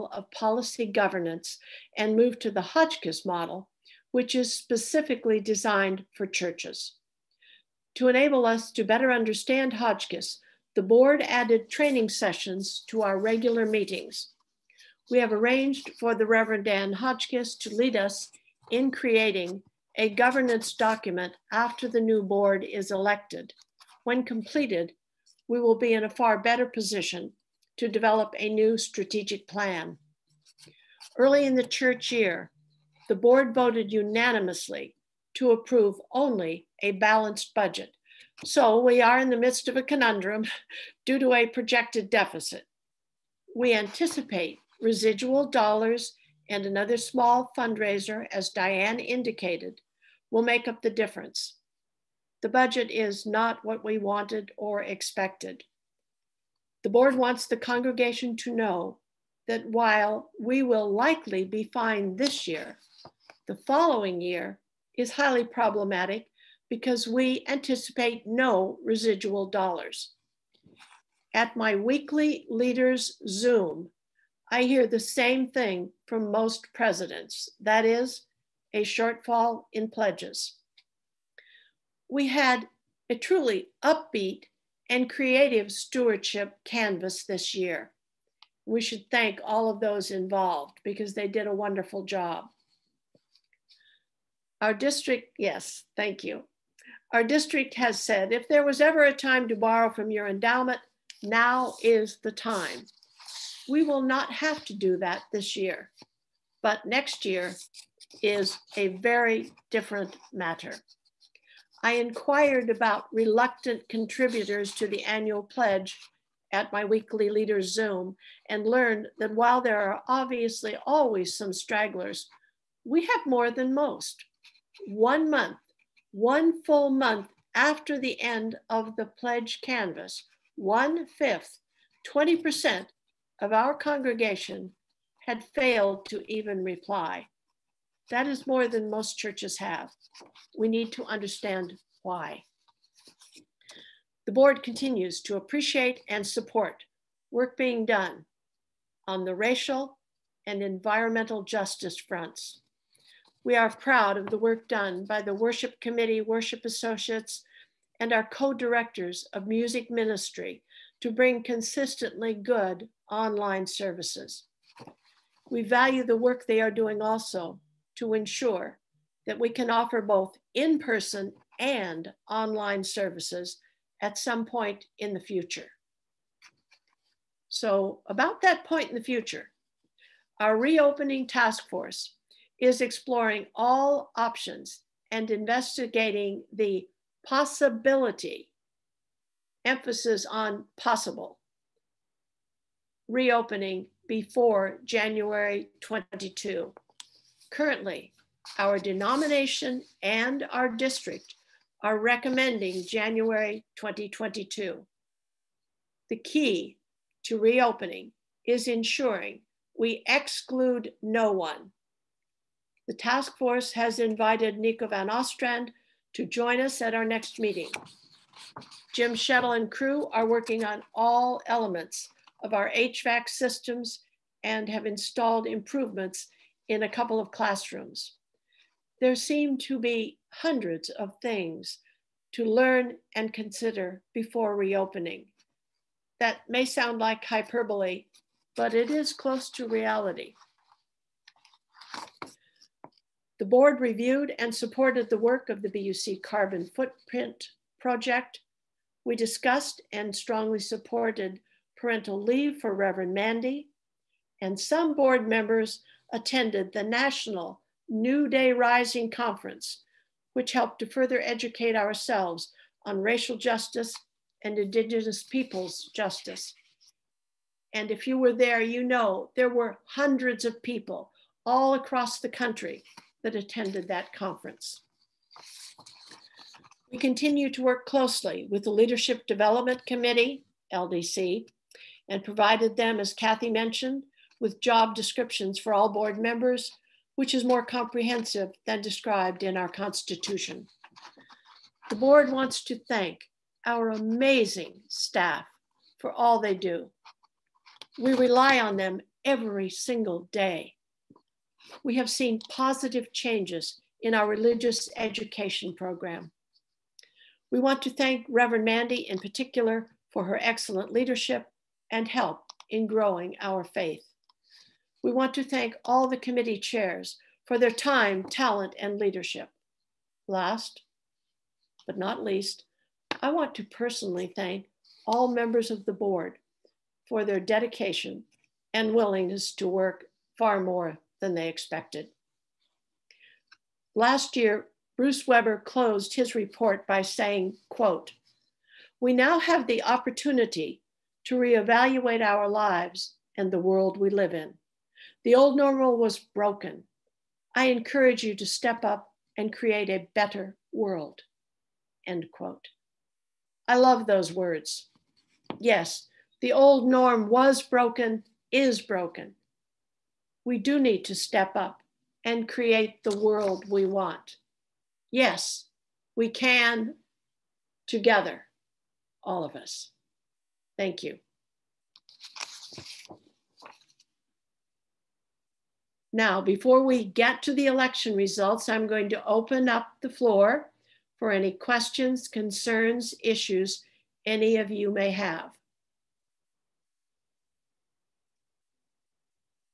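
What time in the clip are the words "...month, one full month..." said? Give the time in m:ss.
2:05.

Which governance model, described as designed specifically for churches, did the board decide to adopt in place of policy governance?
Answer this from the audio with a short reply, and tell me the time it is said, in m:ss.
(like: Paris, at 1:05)
Hotchkiss model, at 0:02.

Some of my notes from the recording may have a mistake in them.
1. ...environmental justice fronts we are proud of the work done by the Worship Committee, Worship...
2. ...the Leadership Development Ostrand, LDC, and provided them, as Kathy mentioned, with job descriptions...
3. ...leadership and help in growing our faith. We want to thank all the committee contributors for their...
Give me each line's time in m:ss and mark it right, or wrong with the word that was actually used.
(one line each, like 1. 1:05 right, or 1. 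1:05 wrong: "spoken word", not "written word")
1. 2:30 right
2. 4:38 wrong: "Committee", not "Ostrand"
3. 5:10 wrong: "chairs", not "contributors".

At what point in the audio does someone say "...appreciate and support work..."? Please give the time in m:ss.
2:25.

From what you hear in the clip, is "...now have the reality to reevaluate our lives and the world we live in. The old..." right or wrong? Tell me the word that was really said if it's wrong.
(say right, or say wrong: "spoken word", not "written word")
wrong: "opportunity", not "reality".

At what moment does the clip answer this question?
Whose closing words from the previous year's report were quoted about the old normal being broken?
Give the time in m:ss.
5:34.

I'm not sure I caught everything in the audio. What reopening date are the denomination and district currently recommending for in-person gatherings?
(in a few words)
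January 2022.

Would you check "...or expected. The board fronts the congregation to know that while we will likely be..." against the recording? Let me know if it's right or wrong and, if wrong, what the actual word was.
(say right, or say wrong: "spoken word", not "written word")
wrong: "wants", not "fronts".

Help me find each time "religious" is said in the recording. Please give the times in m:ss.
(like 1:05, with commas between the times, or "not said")
5:04.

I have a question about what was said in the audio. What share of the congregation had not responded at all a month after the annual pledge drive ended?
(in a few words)
20%.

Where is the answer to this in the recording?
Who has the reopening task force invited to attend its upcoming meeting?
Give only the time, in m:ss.
3:34.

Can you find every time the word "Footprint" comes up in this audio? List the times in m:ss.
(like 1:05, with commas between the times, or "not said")
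4:06.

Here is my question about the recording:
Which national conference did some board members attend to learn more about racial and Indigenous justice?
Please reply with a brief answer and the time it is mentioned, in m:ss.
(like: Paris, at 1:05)
New Day Rising, at 4:17.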